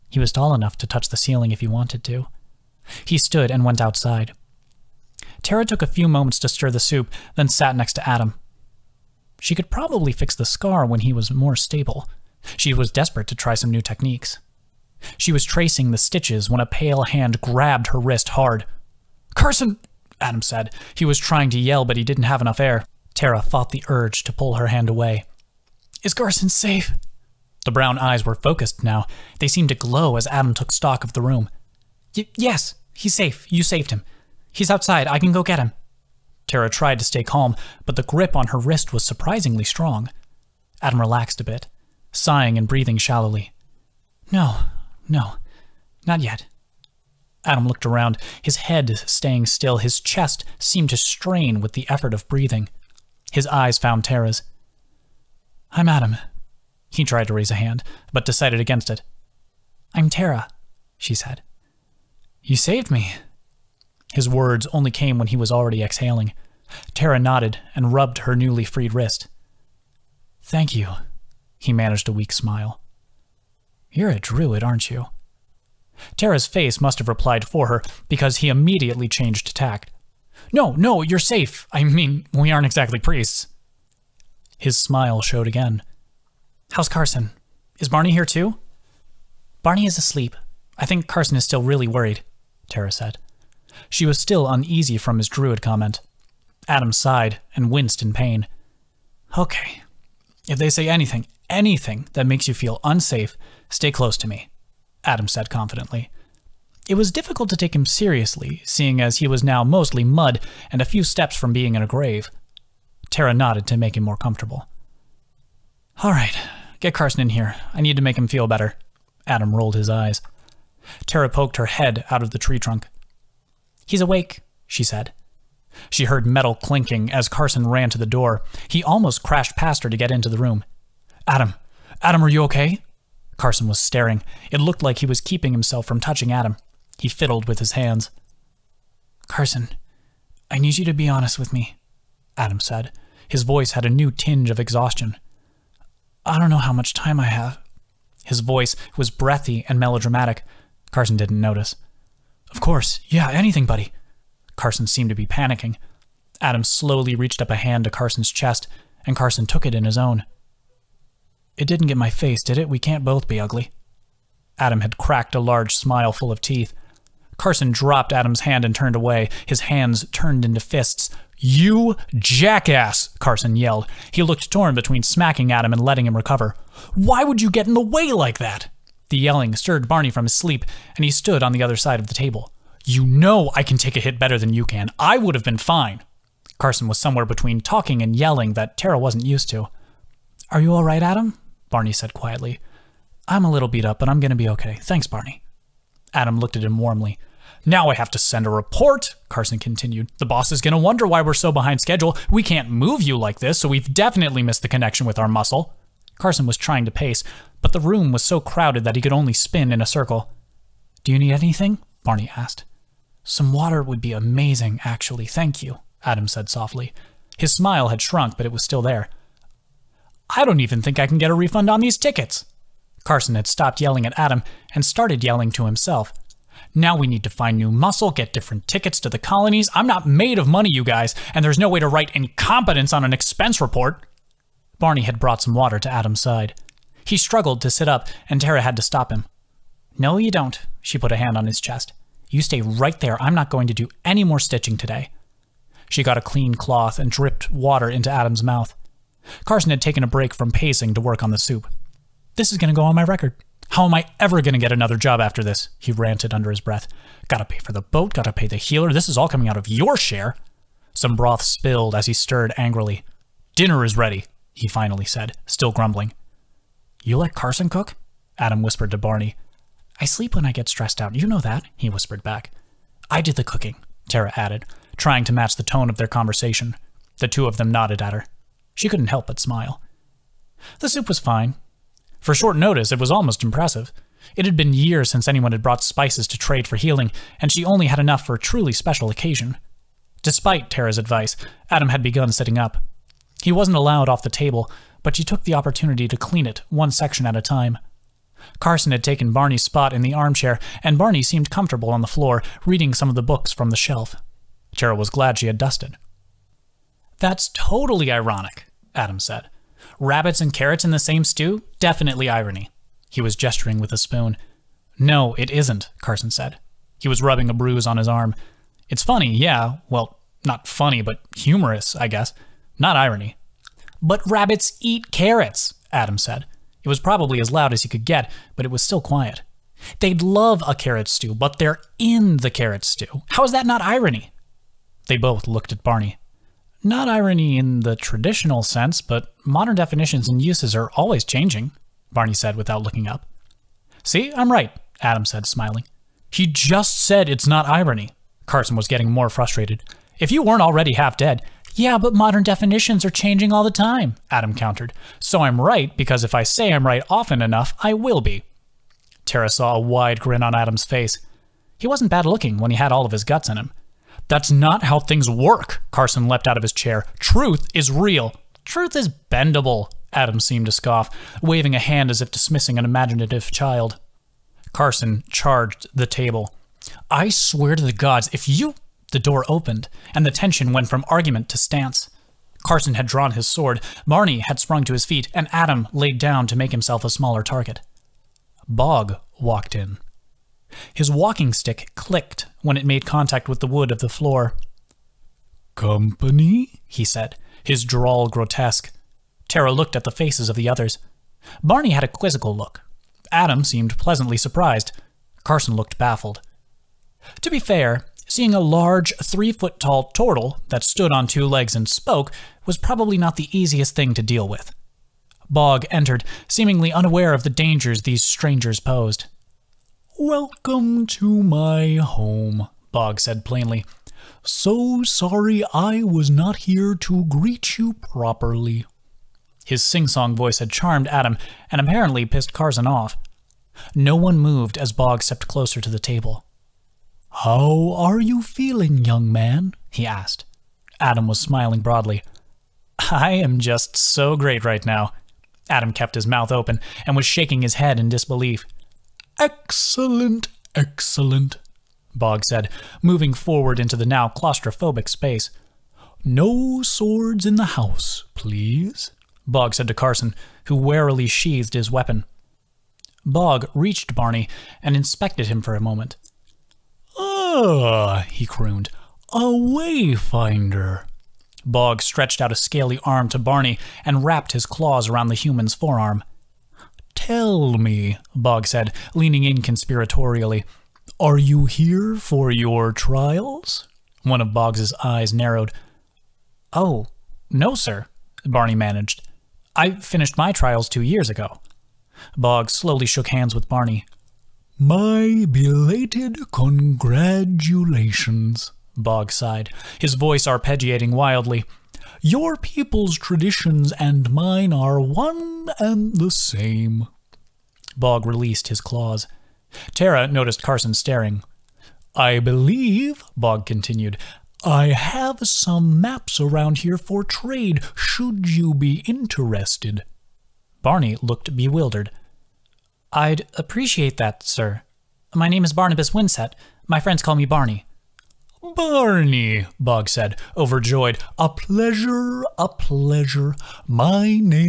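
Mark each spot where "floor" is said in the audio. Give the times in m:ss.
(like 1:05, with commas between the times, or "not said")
5:02, 6:34.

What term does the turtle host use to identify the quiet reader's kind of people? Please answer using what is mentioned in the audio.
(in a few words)
Wayfinder.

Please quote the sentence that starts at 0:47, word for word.
Adam looked around, his head staying still, his chest seemed to strain with the effort of breathing.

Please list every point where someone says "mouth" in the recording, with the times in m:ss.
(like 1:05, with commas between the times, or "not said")
4:08, 7:26.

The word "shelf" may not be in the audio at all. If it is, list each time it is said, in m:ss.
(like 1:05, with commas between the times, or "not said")
5:03.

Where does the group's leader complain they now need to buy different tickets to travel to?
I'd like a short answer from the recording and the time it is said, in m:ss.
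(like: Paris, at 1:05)
The colonies, at 3:49.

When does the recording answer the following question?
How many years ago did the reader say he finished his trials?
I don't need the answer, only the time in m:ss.
8:10.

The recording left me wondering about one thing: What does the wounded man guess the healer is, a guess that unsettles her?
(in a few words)
A druid.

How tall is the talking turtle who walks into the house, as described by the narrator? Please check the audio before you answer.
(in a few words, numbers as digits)
3 feet.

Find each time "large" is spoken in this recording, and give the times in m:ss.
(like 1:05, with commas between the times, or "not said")
2:45, 6:48.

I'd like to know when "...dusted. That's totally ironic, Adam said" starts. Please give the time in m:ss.
5:05.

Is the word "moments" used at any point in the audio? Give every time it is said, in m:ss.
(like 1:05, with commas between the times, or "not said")
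0:06, 7:45.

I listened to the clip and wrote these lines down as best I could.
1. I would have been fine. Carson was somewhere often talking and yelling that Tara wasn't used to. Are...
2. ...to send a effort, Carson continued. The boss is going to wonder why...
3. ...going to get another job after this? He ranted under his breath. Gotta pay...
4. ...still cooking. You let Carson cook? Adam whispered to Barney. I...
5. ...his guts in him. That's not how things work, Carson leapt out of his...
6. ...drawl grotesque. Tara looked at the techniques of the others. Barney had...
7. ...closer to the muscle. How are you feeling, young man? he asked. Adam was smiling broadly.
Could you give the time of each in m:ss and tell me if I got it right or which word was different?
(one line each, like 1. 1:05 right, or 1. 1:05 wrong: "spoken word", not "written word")
1. 3:04 wrong: "between", not "often"
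2. 3:18 wrong: "report", not "effort"
3. 4:14 right
4. 4:25 wrong: "grumbling", not "cooking"
5. 6:03 right
6. 6:37 wrong: "faces", not "techniques"
7. 7:15 wrong: "table", not "muscle".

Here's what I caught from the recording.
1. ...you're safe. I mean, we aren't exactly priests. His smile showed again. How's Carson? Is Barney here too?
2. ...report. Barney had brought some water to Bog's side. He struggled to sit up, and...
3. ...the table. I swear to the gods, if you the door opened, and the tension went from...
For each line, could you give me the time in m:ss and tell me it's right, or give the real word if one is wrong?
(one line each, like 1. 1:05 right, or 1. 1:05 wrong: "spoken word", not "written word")
1. 1:21 right
2. 3:53 wrong: "Adam", not "Bog"
3. 6:15 right.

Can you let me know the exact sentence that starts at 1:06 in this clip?
Tara nodded and rubbed her newly freed wrist.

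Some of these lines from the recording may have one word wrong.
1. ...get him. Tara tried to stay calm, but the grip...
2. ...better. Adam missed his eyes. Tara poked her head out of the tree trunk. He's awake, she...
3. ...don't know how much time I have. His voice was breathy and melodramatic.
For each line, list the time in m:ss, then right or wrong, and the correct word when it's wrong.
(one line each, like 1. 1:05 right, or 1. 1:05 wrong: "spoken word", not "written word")
1. 0:35 right
2. 1:58 wrong: "rolled", not "missed"
3. 2:26 right.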